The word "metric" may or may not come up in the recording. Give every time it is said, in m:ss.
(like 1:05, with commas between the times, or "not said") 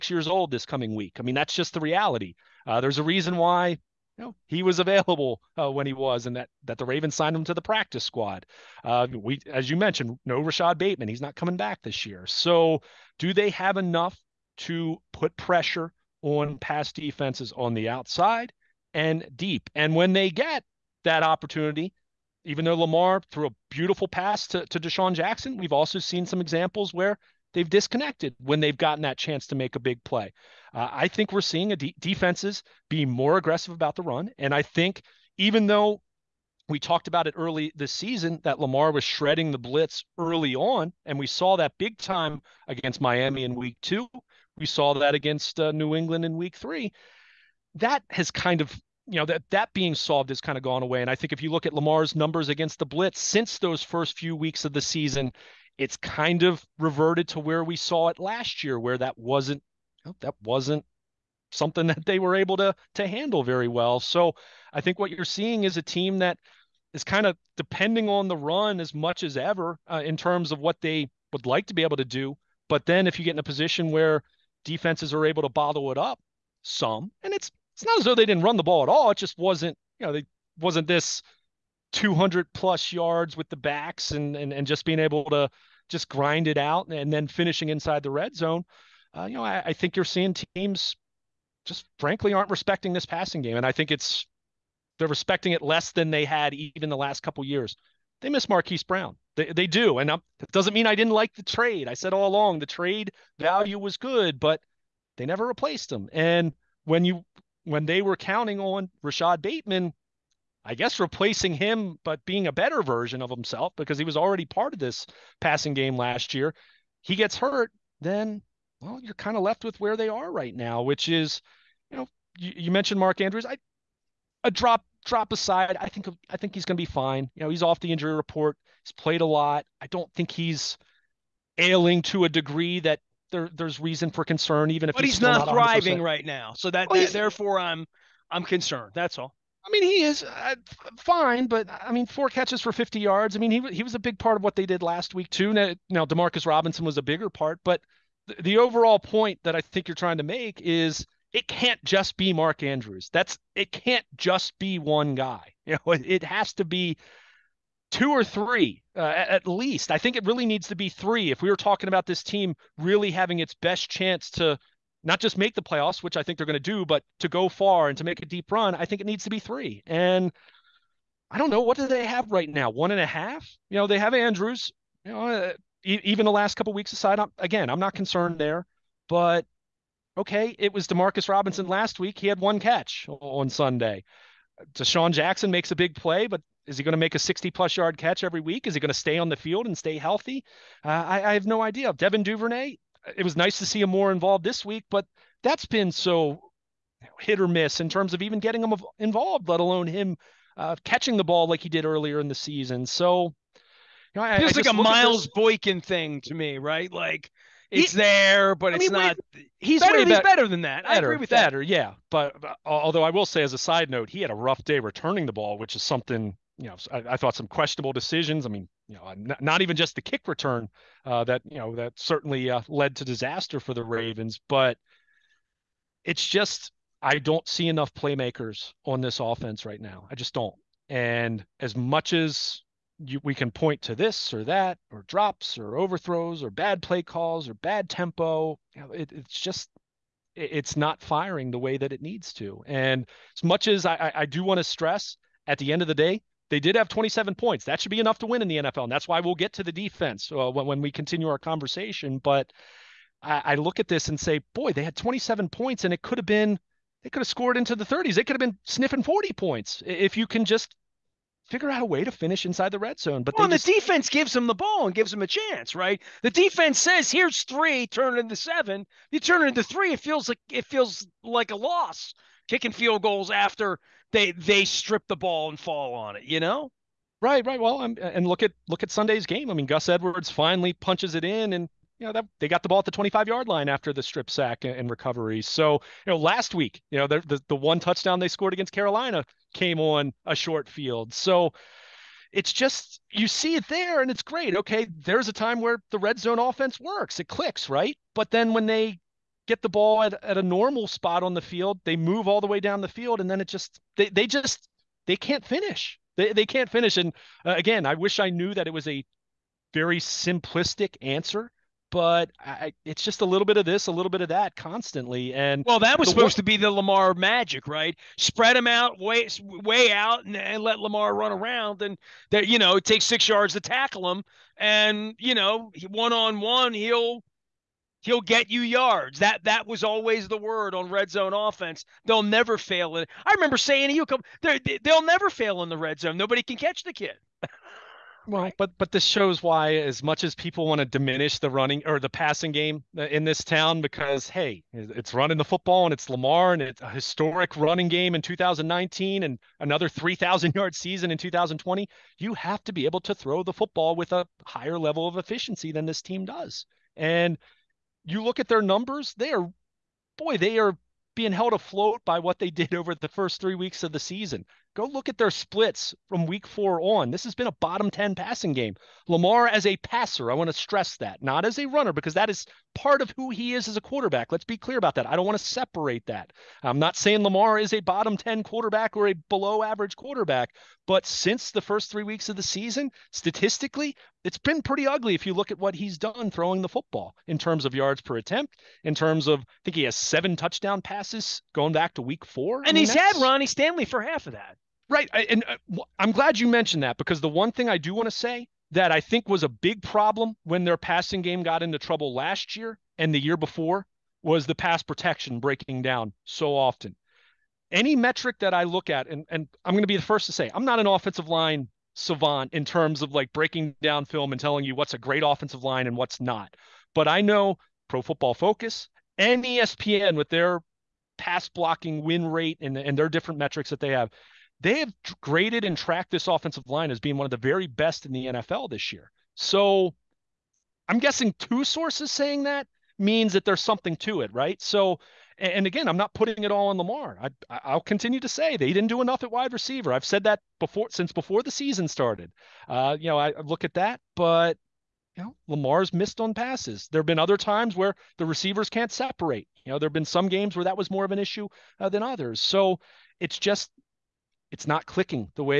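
6:47, 7:03.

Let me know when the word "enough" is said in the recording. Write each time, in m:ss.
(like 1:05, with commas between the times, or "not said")
0:13, 3:47, 4:07, 7:19.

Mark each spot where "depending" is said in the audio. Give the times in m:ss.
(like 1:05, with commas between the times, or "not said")
1:07.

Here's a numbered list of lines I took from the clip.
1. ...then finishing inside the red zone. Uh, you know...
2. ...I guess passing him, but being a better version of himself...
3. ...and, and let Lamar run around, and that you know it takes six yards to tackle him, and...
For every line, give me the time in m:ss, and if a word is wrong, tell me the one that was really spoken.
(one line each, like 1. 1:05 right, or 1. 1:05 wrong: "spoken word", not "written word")
1. 1:27 right
2. 1:50 wrong: "replacing", not "passing"
3. 5:20 right.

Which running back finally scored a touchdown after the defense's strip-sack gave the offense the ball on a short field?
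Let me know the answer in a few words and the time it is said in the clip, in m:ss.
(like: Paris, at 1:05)
Gus Edwards, at 4:39.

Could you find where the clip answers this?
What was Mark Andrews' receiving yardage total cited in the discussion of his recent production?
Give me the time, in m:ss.
2:22.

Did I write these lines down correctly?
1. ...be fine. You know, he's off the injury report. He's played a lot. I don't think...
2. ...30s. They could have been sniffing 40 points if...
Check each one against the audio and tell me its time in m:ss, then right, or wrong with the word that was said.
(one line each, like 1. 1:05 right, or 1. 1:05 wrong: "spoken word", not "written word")
1. 2:06 right
2. 4:17 right.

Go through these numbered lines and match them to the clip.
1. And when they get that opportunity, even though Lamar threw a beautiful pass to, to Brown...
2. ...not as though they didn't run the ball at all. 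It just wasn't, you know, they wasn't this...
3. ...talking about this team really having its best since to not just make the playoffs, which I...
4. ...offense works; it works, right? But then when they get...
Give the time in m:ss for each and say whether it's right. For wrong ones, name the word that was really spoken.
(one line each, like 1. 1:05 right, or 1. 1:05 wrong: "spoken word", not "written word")
1. 0:19 wrong: "DeSean", not "Brown"
2. 1:17 right
3. 2:41 wrong: "chance", not "since"
4. 4:56 wrong: "clicks", not "works".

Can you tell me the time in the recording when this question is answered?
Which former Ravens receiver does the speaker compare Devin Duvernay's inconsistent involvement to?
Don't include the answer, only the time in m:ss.
3:24.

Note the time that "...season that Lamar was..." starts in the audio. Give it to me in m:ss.
0:37.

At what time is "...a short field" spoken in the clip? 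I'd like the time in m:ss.
4:50.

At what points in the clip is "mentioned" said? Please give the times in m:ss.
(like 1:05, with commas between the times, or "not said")
0:09, 2:02, 6:36.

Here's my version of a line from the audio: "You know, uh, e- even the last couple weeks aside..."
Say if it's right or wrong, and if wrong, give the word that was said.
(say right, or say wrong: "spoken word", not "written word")
right.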